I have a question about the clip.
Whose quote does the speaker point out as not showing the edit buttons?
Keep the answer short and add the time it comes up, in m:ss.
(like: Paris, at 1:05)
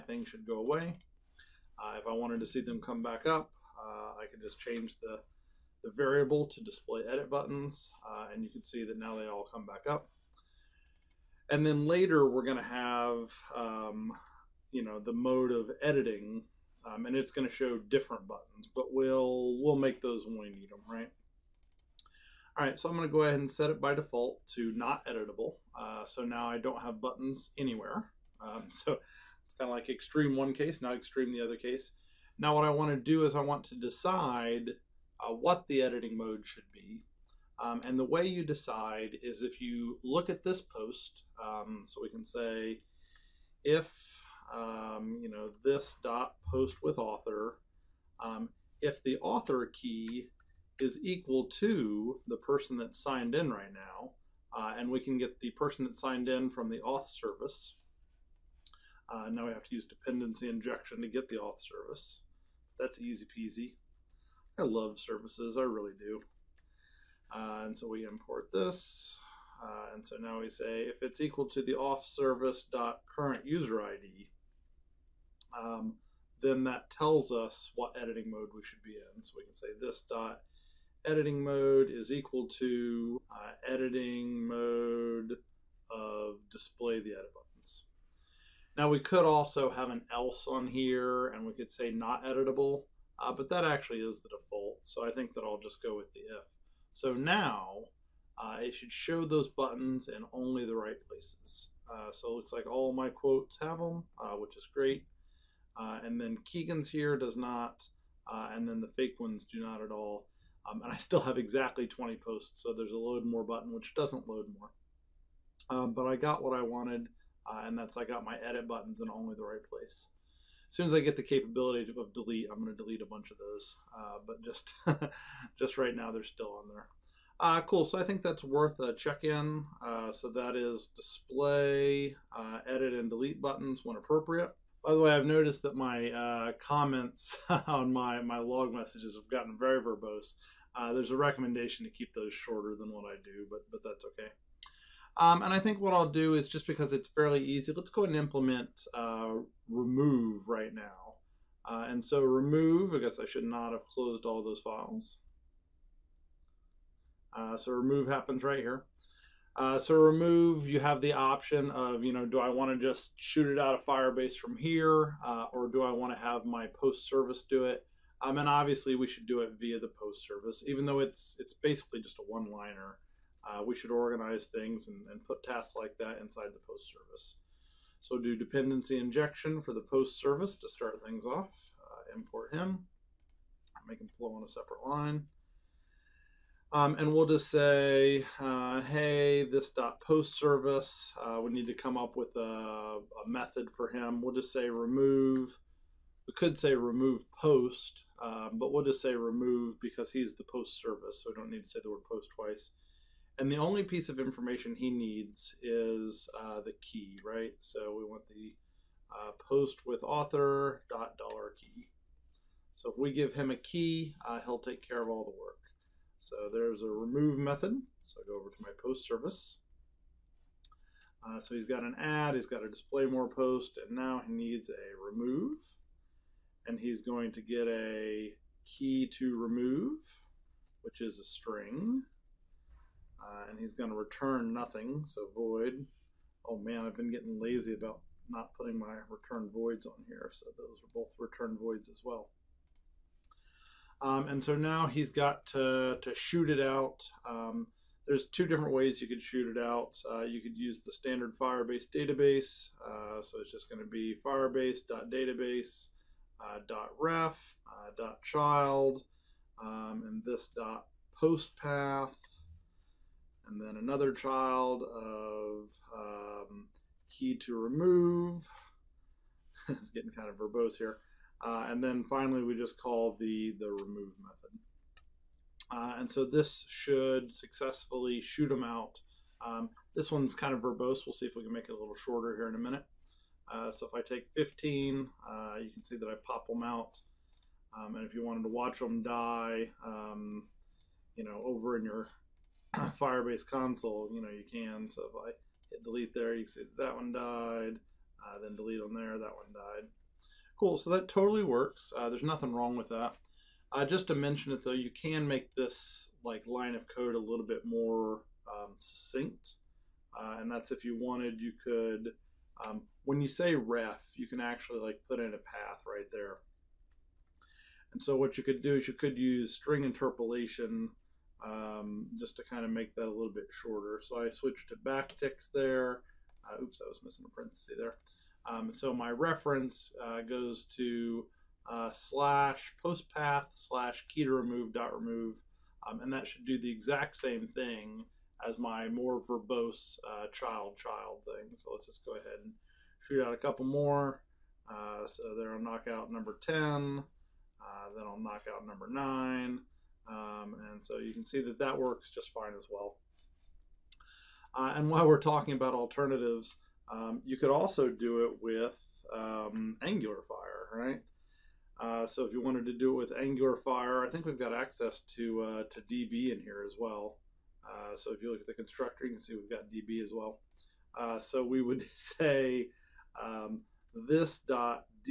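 Keegan, at 1:46.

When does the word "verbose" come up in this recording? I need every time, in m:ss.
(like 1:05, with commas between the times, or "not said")
2:19, 4:30, 4:40, 5:39.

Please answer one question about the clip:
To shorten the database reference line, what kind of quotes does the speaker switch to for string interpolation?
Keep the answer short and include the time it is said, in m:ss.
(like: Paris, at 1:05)
backticks, at 5:24.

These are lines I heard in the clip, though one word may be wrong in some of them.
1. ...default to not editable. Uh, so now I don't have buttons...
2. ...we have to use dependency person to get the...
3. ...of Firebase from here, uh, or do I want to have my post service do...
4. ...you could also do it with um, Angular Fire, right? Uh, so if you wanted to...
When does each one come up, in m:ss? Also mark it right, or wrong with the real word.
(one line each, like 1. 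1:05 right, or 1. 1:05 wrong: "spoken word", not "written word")
1. 0:23 right
2. 0:59 wrong: "injection", not "person"
3. 2:43 right
4. 5:57 right.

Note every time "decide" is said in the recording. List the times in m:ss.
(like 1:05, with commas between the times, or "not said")
0:33, 0:38.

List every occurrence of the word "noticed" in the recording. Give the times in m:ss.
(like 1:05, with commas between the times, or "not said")
2:15.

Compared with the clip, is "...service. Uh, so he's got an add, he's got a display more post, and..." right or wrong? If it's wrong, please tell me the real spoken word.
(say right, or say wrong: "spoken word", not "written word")
right.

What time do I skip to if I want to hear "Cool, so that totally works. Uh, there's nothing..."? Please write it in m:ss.
5:00.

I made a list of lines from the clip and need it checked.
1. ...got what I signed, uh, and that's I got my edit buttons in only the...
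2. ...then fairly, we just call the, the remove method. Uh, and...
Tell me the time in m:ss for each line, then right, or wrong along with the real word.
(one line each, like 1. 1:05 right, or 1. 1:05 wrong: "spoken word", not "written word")
1. 1:56 wrong: "wanted", not "signed"
2. 4:31 wrong: "finally", not "fairly".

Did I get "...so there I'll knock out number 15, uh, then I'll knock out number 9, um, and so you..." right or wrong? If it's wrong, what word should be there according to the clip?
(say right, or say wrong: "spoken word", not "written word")
wrong: "10", not "15".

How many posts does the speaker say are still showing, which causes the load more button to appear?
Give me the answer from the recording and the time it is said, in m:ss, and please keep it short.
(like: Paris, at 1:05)
20, at 1:51.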